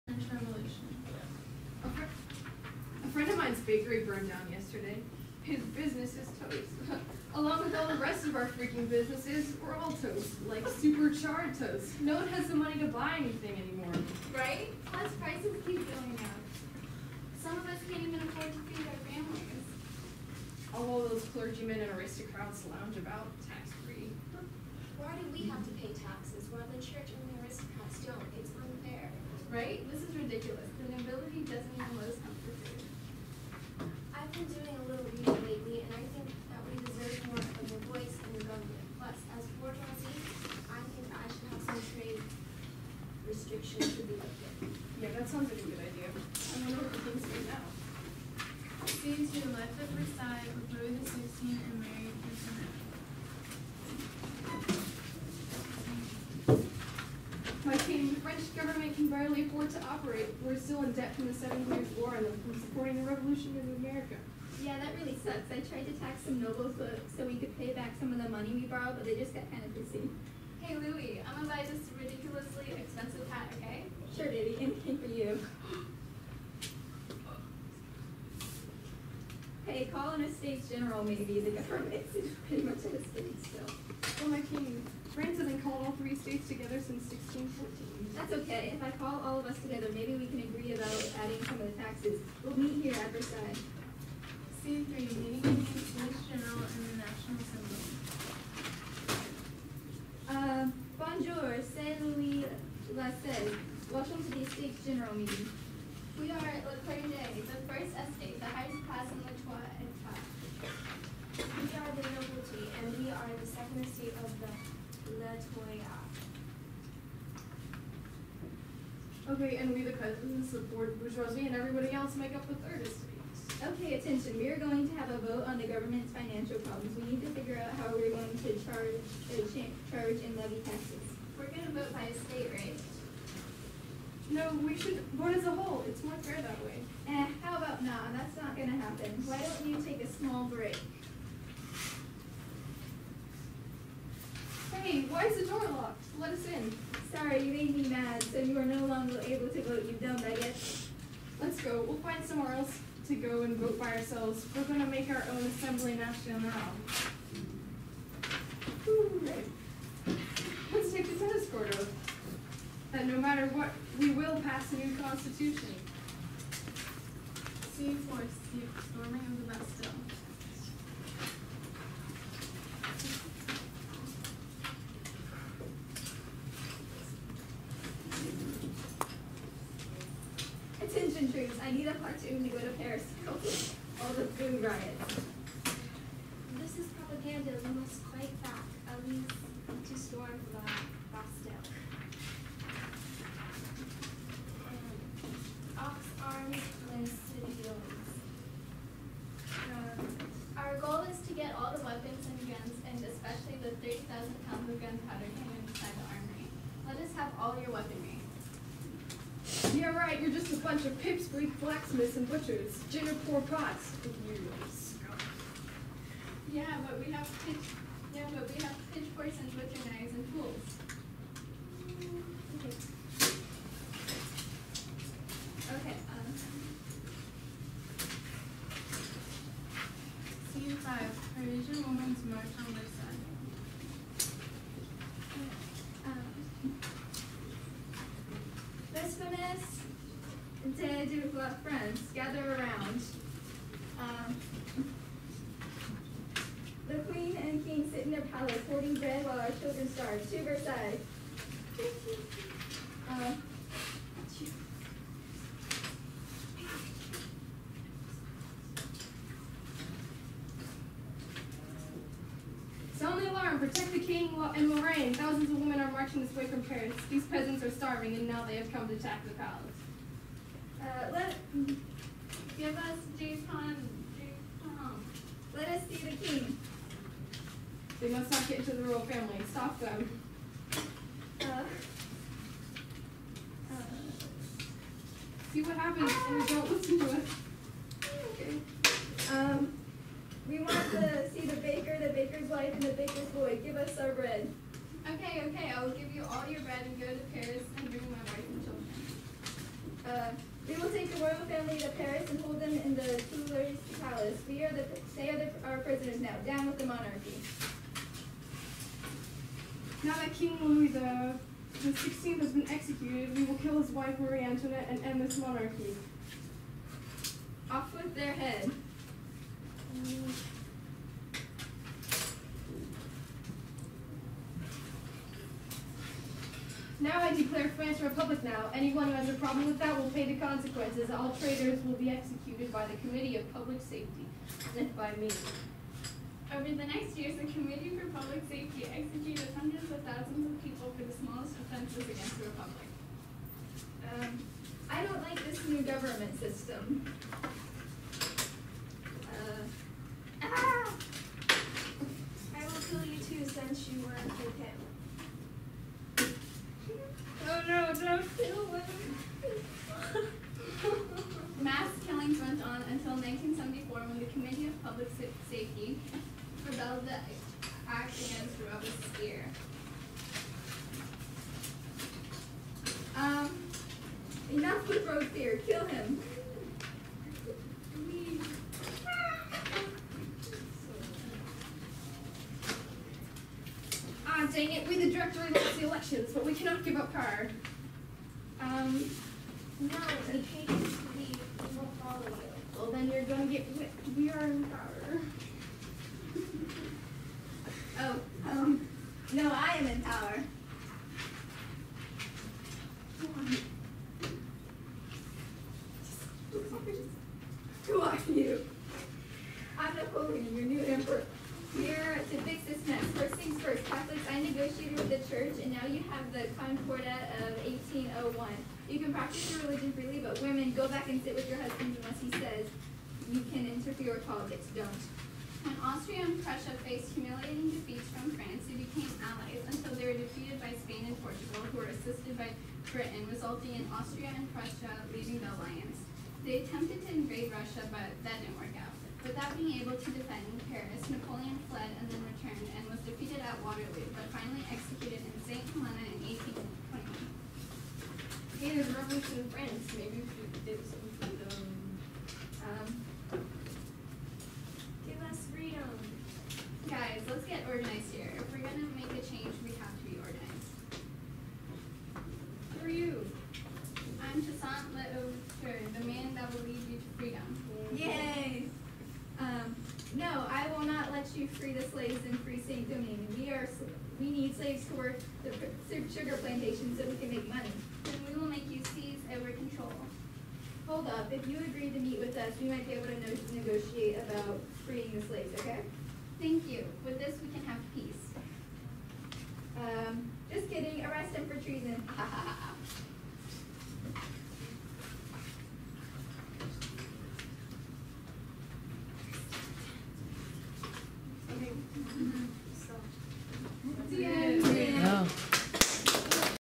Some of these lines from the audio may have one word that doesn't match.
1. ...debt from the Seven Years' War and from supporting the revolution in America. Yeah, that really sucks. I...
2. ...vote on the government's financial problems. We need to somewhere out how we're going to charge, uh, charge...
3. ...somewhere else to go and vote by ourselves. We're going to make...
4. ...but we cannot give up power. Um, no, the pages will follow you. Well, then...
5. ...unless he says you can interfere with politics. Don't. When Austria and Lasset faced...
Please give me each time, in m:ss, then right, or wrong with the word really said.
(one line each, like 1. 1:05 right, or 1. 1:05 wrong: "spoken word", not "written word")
1. 1:00 right
2. 2:05 wrong: "figure", not "somewhere"
3. 2:32 right
4. 6:26 right
5. 7:02 wrong: "Prussia", not "Lasset".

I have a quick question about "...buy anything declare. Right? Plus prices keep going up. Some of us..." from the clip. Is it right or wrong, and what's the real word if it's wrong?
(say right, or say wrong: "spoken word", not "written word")
wrong: "anymore", not "declare".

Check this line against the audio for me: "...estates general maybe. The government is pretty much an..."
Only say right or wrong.
right.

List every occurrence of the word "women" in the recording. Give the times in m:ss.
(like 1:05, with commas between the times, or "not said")
4:25, 7:00.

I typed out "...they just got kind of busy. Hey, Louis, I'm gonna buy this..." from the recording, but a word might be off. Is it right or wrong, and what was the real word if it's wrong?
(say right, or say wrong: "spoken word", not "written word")
right.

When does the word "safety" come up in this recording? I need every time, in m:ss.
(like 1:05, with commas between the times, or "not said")
5:33, 5:38, 6:05.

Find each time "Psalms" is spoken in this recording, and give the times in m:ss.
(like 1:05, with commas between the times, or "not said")
not said.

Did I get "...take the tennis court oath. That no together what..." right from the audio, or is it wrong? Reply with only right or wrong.
wrong.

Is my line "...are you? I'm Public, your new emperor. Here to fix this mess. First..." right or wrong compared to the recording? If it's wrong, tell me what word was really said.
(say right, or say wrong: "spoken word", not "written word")
wrong: "Napoleon", not "Public".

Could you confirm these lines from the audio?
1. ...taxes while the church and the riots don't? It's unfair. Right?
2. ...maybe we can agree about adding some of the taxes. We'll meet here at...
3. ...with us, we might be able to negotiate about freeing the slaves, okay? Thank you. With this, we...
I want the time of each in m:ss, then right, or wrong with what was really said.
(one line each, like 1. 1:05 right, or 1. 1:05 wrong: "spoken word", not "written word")
1. 0:25 wrong: "aristocrats", not "riots"
2. 1:29 right
3. 8:02 right.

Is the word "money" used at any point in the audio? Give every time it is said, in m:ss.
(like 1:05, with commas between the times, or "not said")
0:12, 1:08, 7:57.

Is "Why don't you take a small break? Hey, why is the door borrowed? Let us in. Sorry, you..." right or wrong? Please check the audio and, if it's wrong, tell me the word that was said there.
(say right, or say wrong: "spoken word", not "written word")
wrong: "locked", not "borrowed".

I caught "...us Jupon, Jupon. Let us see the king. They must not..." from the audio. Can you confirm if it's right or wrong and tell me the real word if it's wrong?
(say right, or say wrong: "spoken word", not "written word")
right.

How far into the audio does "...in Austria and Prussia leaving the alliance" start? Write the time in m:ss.
7:13.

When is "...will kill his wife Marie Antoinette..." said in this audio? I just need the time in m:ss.
5:13.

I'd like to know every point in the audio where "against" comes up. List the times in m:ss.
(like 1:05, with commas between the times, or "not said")
5:42, 6:08.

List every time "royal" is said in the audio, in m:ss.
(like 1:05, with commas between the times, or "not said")
4:38, 5:01.